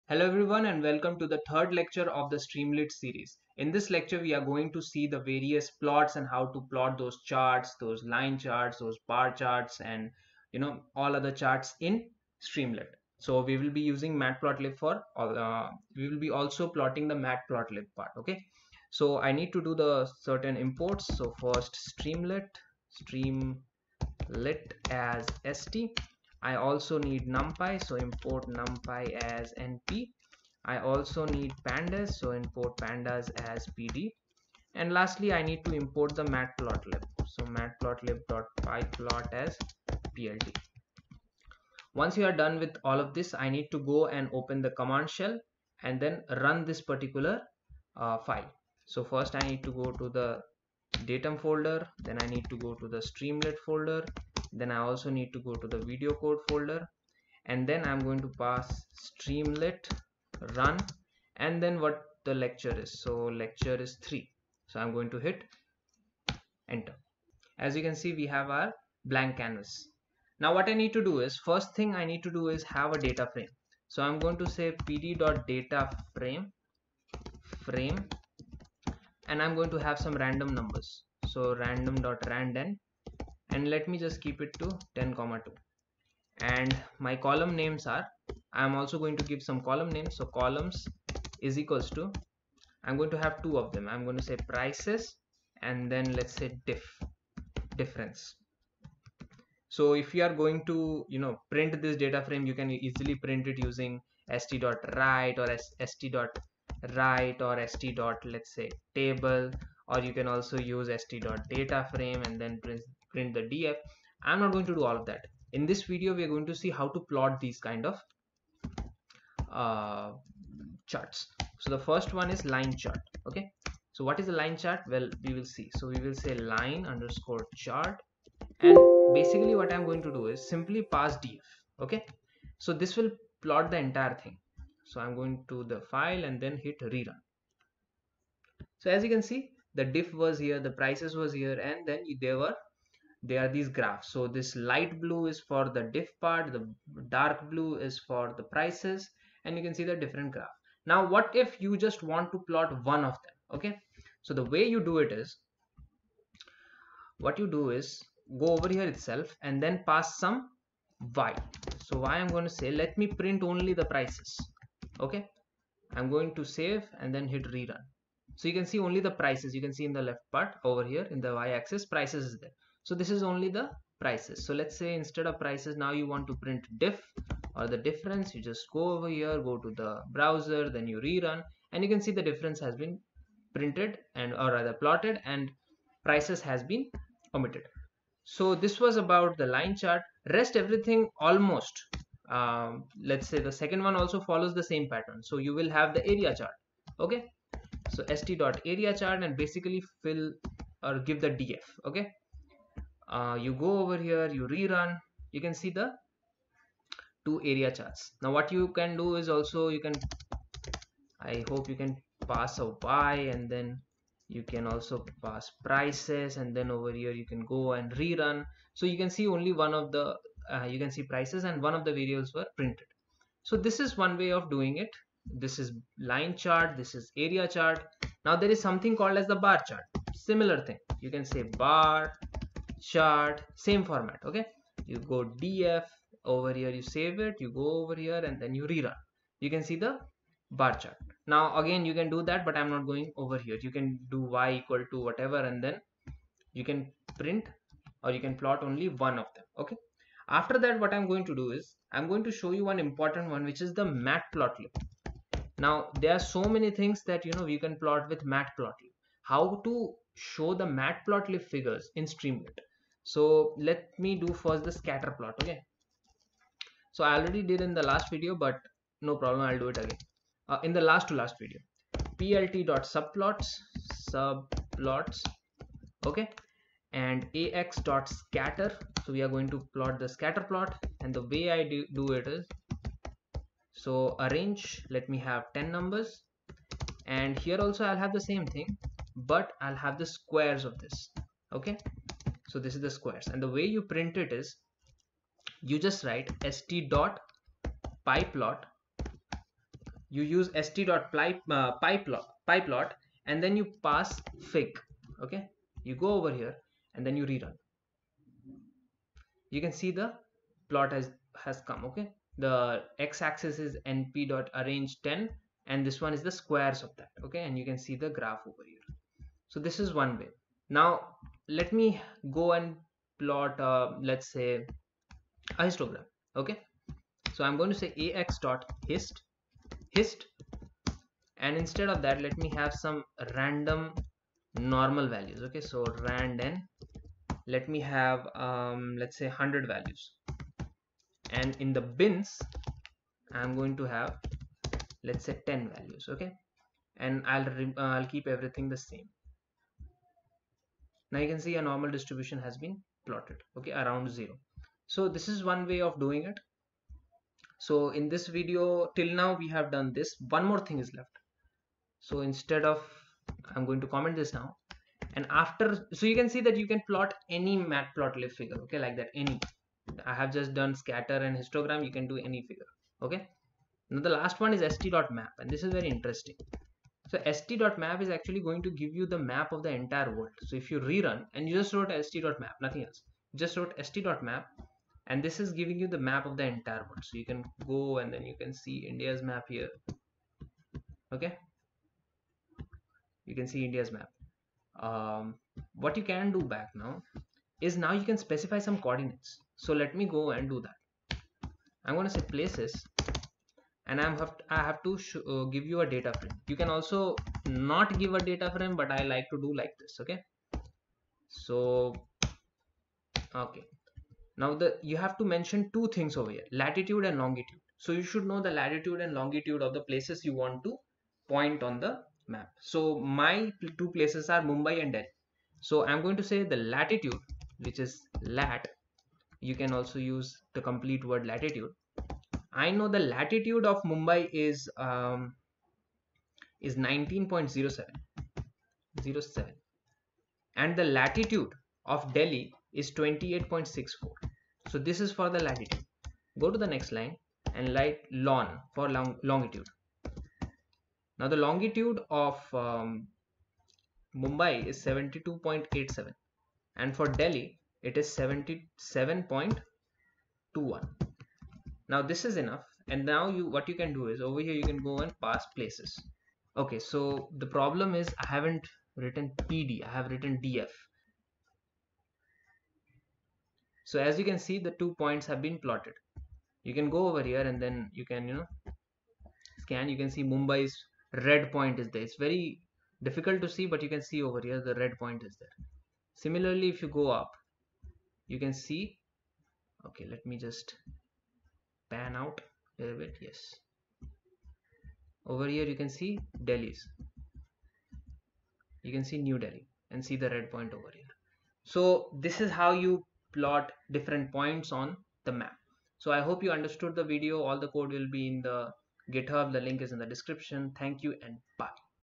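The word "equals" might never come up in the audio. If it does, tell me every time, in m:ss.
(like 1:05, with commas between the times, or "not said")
1:31, 4:04.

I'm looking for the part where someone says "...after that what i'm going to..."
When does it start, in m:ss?
4:10.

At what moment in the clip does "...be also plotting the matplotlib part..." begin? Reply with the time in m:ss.
0:16.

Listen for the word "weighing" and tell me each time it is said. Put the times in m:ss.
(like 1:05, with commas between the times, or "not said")
not said.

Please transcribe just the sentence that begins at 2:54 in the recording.
So let's say instead of prices, now you want to print diff or the difference.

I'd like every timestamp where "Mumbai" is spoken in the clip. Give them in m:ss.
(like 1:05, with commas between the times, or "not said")
7:04, 7:13, 7:34, 8:00.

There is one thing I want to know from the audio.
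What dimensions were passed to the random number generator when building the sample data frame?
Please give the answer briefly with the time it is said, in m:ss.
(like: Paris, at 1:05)
10 by 2, at 1:24.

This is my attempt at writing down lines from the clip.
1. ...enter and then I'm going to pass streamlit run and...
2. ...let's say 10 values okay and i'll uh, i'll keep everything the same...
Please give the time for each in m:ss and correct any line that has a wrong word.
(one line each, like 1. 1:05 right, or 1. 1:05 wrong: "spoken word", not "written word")
1. 0:56 wrong: "folder", not "enter"
2. 5:45 right.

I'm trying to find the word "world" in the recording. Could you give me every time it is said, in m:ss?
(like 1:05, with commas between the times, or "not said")
6:20, 6:26.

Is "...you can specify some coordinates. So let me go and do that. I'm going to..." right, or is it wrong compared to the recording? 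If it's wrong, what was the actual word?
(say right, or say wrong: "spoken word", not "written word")
right.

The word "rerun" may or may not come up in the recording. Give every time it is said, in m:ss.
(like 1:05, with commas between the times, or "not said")
2:16, 2:47, 3:00, 3:24, 3:38, 3:58, 5:07, 6:20.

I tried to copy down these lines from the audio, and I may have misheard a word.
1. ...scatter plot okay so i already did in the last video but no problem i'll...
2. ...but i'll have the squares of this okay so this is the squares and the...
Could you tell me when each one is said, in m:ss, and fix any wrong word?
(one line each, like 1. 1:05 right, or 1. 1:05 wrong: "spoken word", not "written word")
1. 4:24 right
2. 4:49 right.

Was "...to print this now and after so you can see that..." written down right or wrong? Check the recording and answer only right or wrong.
wrong.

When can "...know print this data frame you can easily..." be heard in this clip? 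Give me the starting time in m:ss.
1:41.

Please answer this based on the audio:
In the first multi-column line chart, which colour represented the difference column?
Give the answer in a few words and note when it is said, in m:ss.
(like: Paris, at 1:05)
light blue, at 2:24.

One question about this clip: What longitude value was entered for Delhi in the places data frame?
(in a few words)
77.21.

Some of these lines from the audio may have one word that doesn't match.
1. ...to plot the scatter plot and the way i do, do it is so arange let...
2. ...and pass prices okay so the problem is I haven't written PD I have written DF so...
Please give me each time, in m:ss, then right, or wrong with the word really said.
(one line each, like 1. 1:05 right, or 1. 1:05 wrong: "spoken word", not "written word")
1. 4:39 right
2. 7:45 wrong: "places", not "prices".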